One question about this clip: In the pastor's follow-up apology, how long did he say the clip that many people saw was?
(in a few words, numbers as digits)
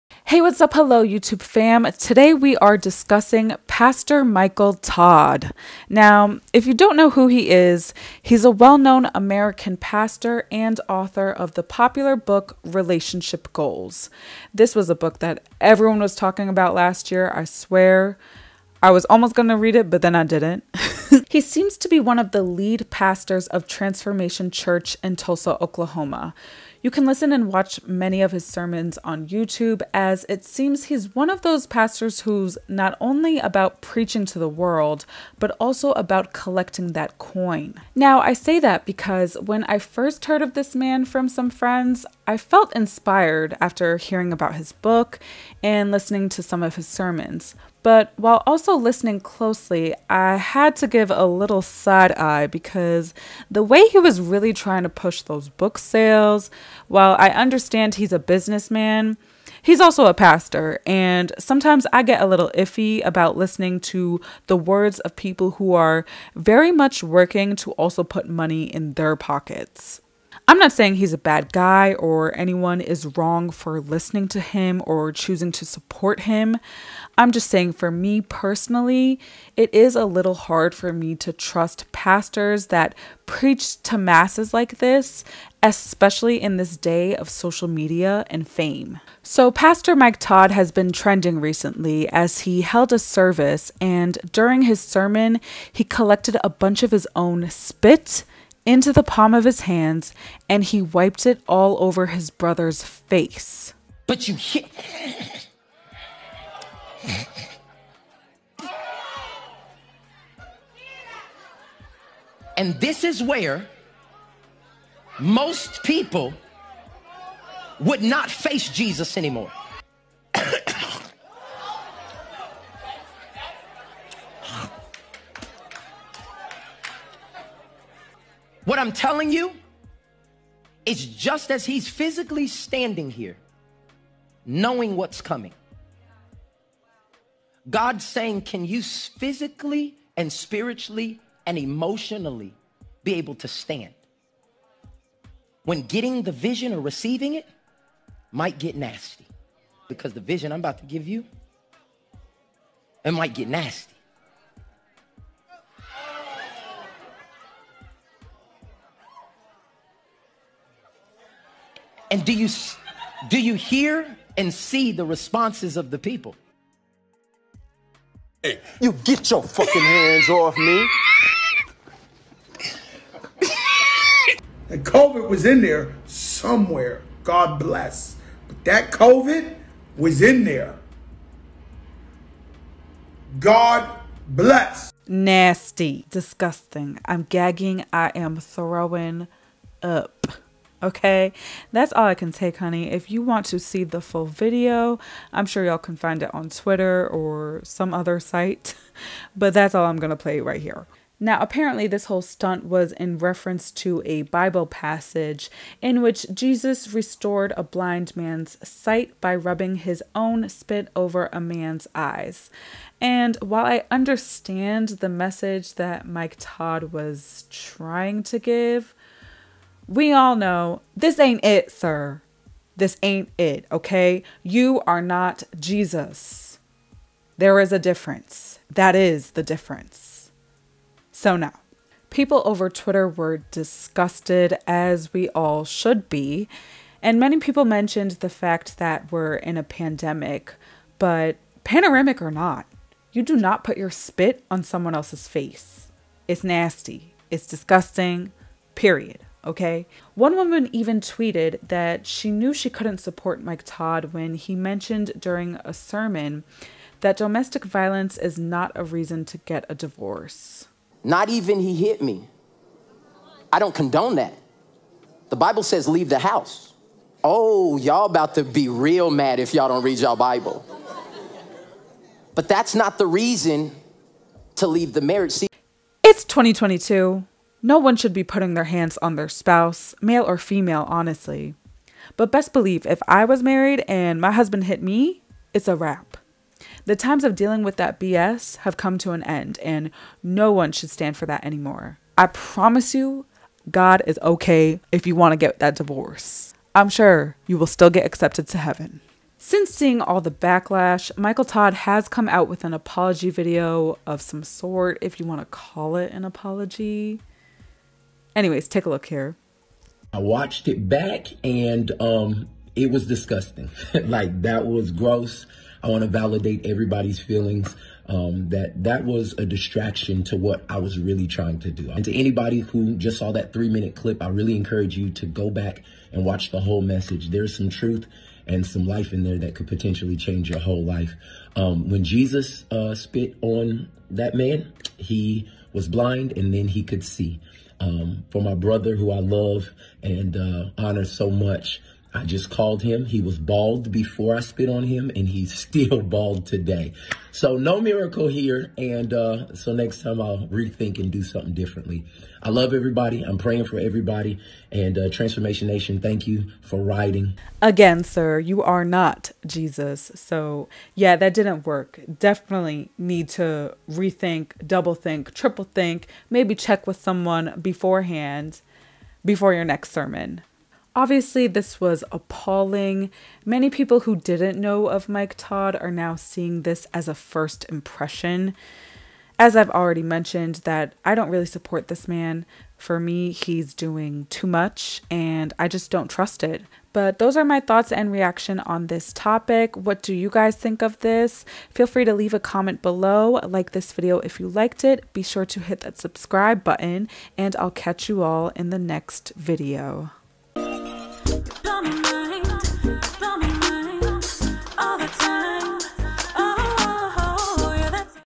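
3 minutes.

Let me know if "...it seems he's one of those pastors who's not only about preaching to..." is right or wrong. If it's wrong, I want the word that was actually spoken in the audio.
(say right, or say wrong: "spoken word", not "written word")
right.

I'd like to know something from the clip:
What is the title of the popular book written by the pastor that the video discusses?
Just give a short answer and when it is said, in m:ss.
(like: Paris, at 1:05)
Relationship Goals, at 0:12.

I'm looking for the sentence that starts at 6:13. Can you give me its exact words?
Many people who didn't know of Mike Todd are now seeing this as a first impression.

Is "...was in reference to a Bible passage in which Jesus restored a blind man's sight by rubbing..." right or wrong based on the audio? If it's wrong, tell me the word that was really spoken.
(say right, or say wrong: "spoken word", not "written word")
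right.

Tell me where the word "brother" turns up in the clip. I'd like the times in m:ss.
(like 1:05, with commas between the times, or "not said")
1:42, 5:38.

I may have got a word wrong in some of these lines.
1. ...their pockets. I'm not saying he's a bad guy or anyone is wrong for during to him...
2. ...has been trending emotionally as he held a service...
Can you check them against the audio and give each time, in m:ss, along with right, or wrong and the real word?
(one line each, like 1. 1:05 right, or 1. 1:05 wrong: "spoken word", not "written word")
1. 1:08 wrong: "listening", not "during"
2. 1:30 wrong: "recently", not "emotionally".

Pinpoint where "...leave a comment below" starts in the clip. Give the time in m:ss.
6:32.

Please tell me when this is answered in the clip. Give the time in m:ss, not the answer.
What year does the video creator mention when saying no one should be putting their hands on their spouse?
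4:36.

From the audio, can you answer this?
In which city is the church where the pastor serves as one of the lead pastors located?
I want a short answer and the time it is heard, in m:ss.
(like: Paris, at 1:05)
Tulsa, Oklahoma, at 0:25.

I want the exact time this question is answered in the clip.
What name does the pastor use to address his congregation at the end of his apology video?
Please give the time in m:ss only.
5:55.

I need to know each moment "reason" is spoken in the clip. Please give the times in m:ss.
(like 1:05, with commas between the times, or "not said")
4:18, 4:33.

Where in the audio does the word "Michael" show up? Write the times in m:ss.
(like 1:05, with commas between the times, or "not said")
0:04, 5:01.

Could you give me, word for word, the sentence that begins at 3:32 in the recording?
And while I understand the message that Mike Todd was trying to give, we all know this ain't it, sir.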